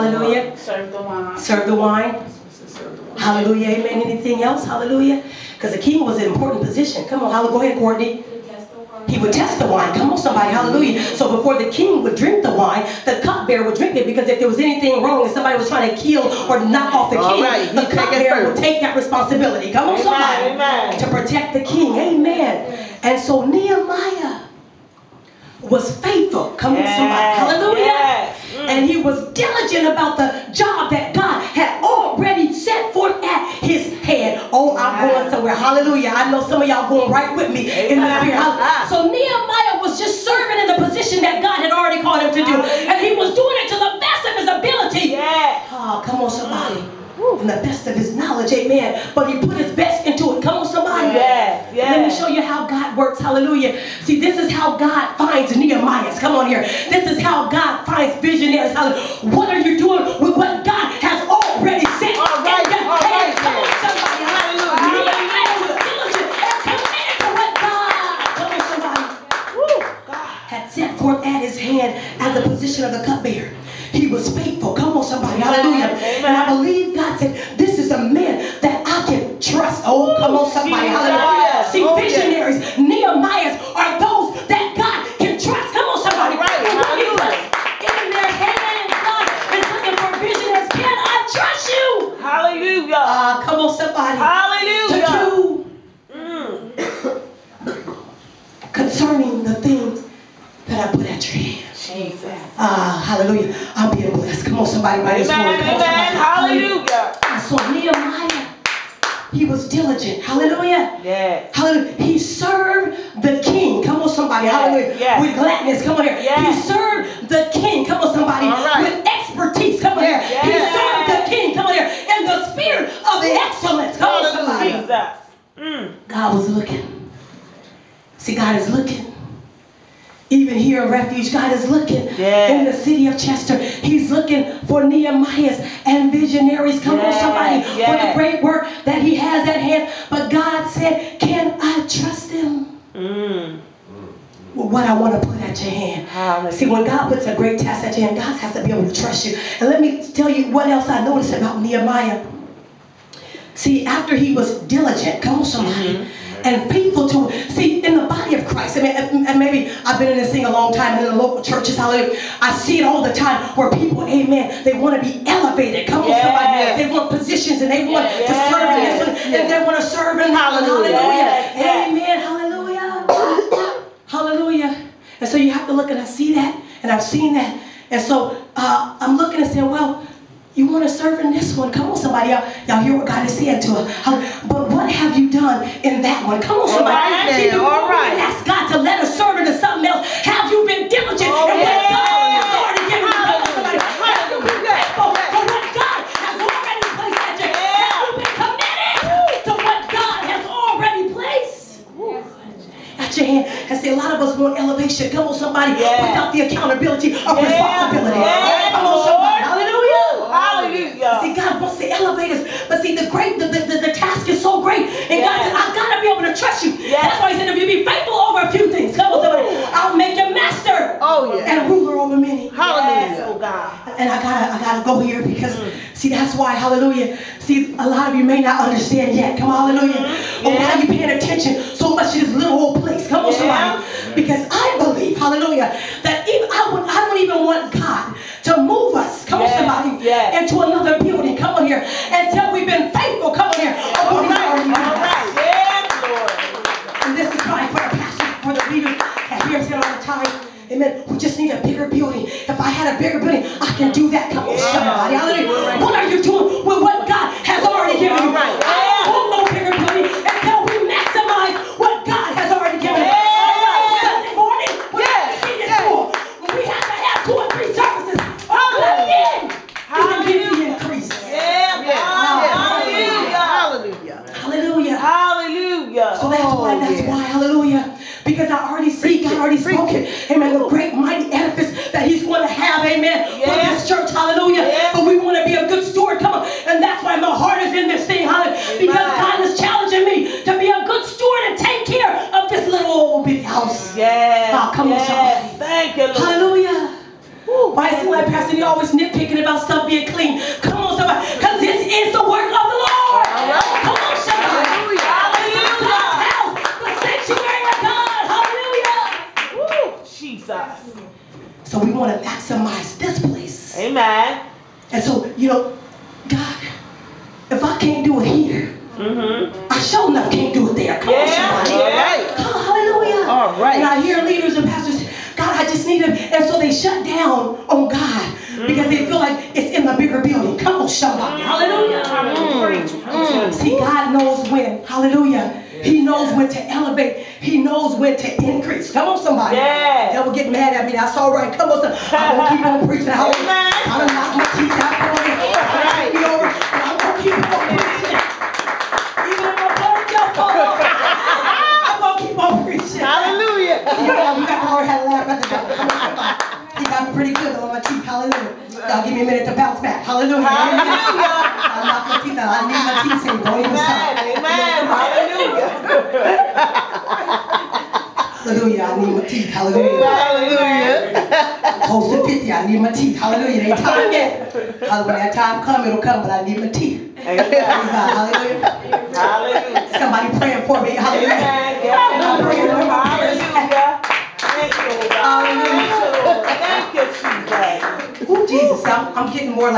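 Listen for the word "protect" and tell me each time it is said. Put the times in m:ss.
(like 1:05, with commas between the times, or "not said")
0:21.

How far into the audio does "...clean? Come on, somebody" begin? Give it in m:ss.
5:00.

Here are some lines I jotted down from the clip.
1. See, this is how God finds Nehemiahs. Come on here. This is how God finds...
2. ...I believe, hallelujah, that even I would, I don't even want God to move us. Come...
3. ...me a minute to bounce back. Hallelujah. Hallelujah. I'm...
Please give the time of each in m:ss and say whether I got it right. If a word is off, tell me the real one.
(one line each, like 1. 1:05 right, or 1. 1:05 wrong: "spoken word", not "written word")
1. 0:54 right
2. 3:54 right
3. 5:59 right.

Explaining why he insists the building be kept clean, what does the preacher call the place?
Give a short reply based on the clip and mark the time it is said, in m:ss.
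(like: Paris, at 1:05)
Sanctuary, at 5:06.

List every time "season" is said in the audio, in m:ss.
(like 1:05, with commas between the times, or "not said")
not said.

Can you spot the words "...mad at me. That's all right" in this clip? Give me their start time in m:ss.
5:40.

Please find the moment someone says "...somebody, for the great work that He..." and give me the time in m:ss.
2:17.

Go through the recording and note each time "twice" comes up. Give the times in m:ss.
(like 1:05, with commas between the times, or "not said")
not said.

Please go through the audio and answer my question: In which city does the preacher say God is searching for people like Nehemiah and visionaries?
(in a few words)
Chester.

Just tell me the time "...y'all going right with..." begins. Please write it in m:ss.
0:36.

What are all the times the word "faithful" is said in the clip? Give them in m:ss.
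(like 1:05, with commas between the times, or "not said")
0:26, 1:14, 3:37, 4:02.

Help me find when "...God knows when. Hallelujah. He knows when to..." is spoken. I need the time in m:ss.
5:33.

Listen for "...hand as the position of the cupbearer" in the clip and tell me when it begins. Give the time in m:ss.
1:11.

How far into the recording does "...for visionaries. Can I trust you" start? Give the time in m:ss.
1:30.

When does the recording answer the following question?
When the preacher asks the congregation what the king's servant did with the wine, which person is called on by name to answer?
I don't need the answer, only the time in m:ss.
0:07.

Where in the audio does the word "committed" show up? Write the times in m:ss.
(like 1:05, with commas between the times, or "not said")
3:18.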